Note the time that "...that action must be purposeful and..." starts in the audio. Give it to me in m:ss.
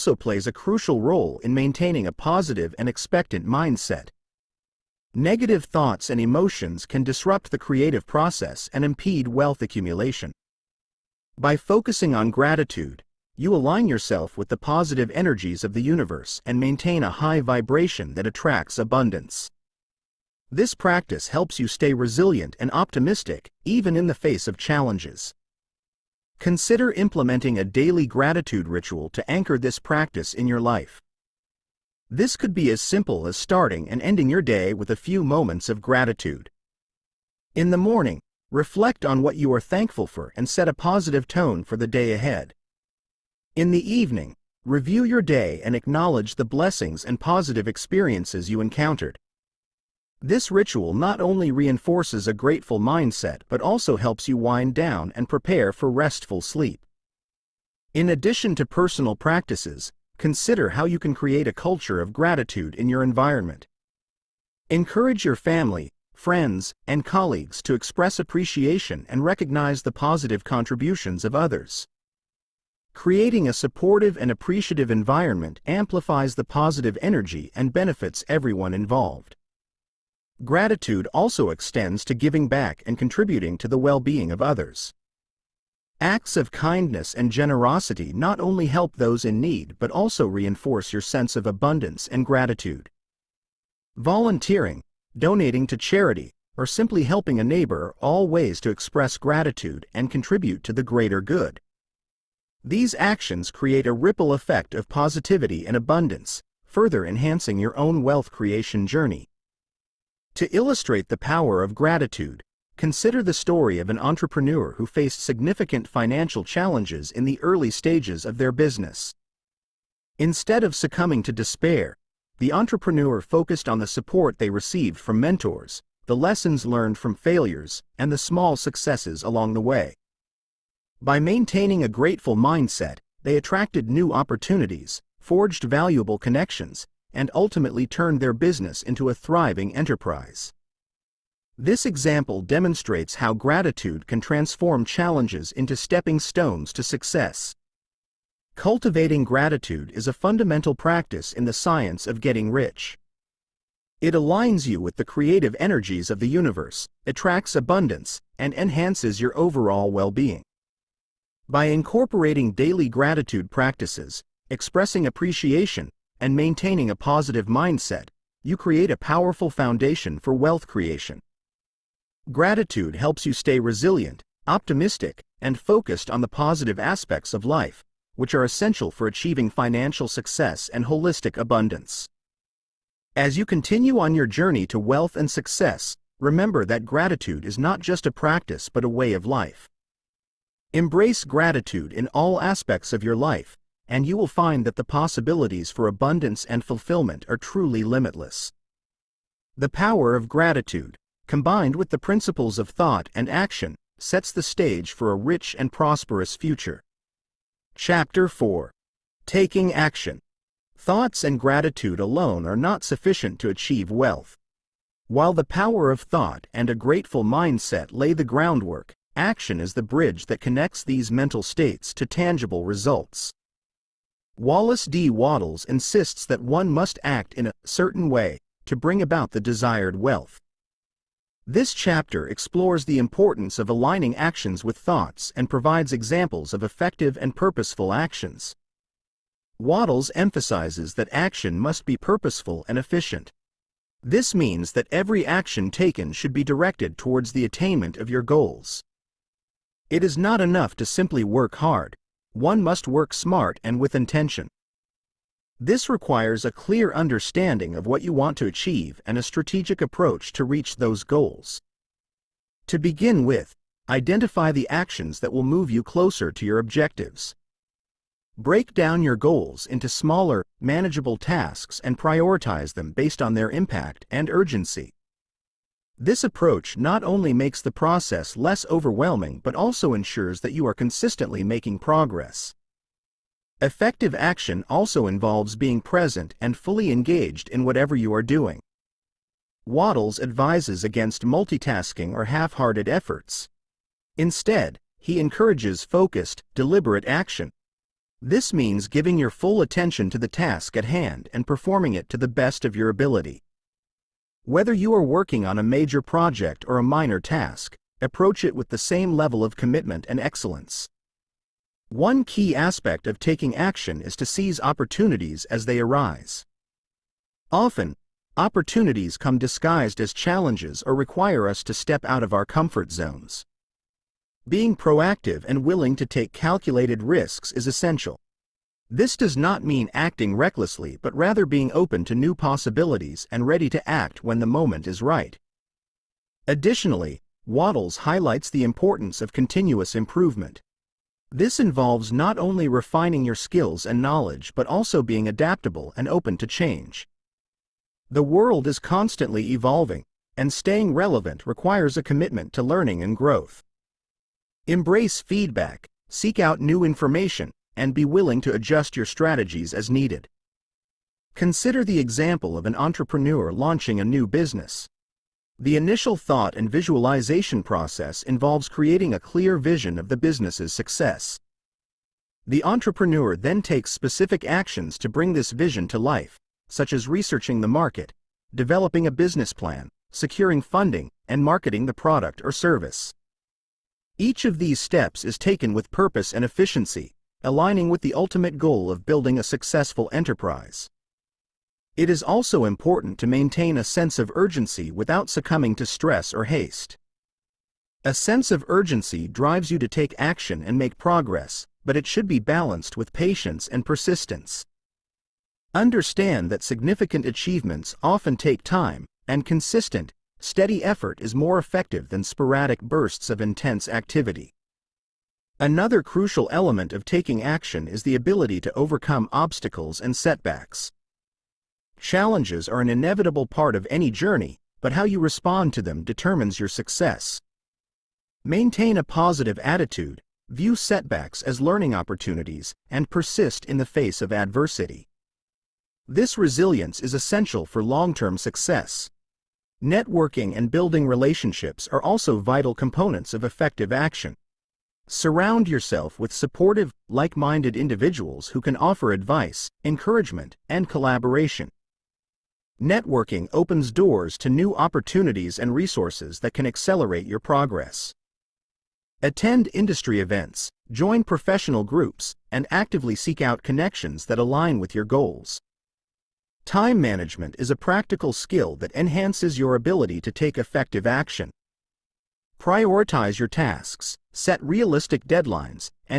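4:00.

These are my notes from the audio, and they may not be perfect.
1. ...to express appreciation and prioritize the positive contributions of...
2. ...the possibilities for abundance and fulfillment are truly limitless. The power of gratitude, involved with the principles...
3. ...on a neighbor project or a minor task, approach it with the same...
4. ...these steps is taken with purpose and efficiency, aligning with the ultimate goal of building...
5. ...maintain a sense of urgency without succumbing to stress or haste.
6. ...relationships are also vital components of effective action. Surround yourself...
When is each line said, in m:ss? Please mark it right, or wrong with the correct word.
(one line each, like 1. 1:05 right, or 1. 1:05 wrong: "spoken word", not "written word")
1. 1:07 wrong: "recognize", not "prioritize"
2. 3:14 wrong: "combined", not "involved"
3. 5:05 wrong: "major", not "neighbor"
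4. 6:24 right
5. 6:33 right
6. 7:21 right.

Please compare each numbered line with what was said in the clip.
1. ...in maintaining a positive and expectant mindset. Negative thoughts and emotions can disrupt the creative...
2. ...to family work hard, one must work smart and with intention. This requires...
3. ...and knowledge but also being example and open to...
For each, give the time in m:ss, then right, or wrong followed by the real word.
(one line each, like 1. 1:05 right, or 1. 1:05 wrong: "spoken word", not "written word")
1. 0:01 right
2. 4:10 wrong: "simply", not "family"
3. 5:43 wrong: "adaptable", not "example".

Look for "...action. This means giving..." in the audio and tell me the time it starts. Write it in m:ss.
4:57.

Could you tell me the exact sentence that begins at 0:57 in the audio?
In addition to personal practices, consider how you can create a culture of gratitude in your environment.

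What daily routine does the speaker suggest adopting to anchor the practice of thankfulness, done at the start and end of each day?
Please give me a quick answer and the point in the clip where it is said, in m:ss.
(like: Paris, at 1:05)
gratitude ritual, at 0:28.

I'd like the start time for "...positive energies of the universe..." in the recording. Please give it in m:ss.
0:14.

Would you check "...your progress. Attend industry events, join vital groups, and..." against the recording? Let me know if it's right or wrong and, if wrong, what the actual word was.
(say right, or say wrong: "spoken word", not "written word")
wrong: "professional", not "vital".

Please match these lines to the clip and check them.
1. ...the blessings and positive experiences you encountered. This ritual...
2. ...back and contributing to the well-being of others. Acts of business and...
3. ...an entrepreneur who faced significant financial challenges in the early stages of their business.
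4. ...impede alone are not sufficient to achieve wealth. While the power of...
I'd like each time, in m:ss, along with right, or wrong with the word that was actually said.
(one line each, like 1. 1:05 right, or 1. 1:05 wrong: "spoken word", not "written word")
1. 0:46 right
2. 1:22 wrong: "kindness", not "business"
3. 1:53 right
4. 3:31 wrong: "gratitude", not "impede".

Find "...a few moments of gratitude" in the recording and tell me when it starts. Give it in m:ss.
0:34.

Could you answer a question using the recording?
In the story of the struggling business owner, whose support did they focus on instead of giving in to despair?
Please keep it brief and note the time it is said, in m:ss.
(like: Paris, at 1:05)
mentors, at 2:05.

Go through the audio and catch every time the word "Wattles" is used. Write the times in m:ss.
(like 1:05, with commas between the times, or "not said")
3:45, 3:59, 4:49, 5:37.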